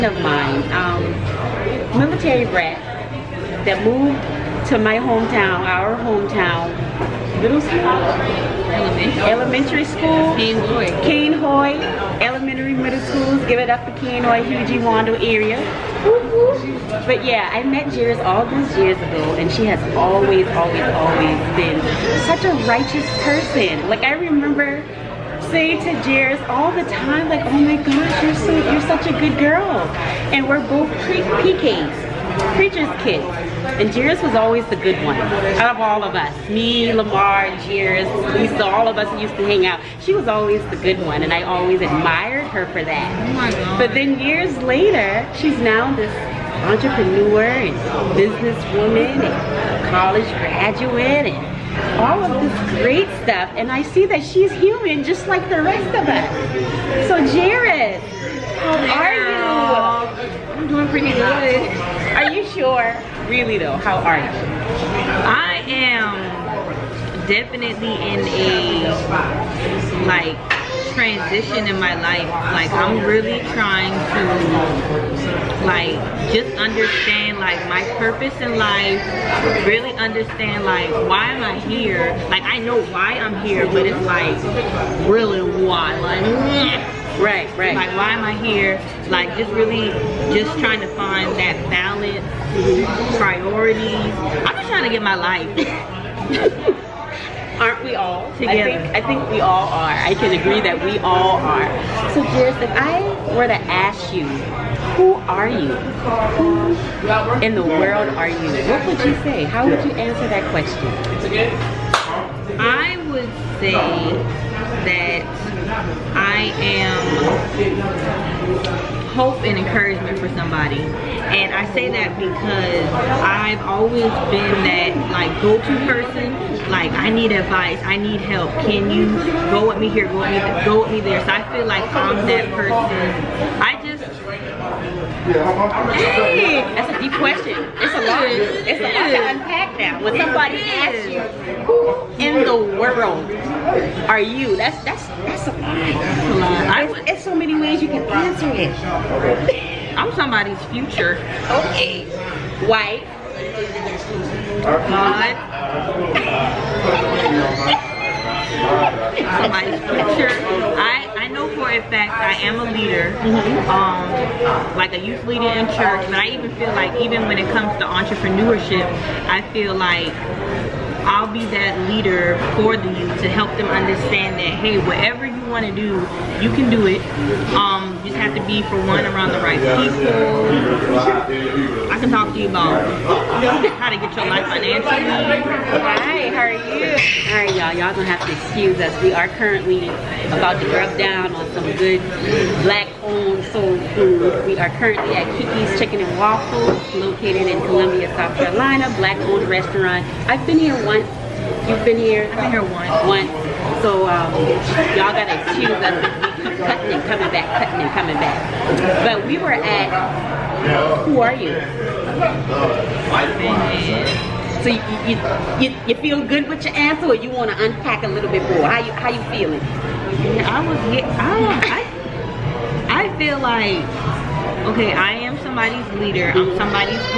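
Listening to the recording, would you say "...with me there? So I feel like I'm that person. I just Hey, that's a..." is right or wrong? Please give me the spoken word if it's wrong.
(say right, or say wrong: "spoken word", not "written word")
right.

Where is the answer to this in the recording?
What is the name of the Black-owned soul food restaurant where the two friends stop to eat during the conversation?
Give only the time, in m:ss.
3:15.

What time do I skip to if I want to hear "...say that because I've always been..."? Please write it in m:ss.
2:01.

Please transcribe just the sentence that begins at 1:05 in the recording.
I am definitely in a like transition in my life.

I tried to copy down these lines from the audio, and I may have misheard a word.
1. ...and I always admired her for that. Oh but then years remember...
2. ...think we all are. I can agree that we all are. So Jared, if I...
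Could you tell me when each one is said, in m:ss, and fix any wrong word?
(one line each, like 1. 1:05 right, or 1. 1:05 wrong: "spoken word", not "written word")
1. 0:41 wrong: "later", not "remember"
2. 1:39 right.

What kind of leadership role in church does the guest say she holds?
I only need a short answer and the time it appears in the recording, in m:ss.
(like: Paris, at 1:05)
youth leader, at 2:45.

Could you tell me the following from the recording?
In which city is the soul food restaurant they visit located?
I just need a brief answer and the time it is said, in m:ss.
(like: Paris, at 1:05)
Columbia, South Carolina, at 3:17.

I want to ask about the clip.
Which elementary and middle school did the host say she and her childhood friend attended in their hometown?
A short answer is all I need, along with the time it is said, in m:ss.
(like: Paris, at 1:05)
Cainhoy, at 0:10.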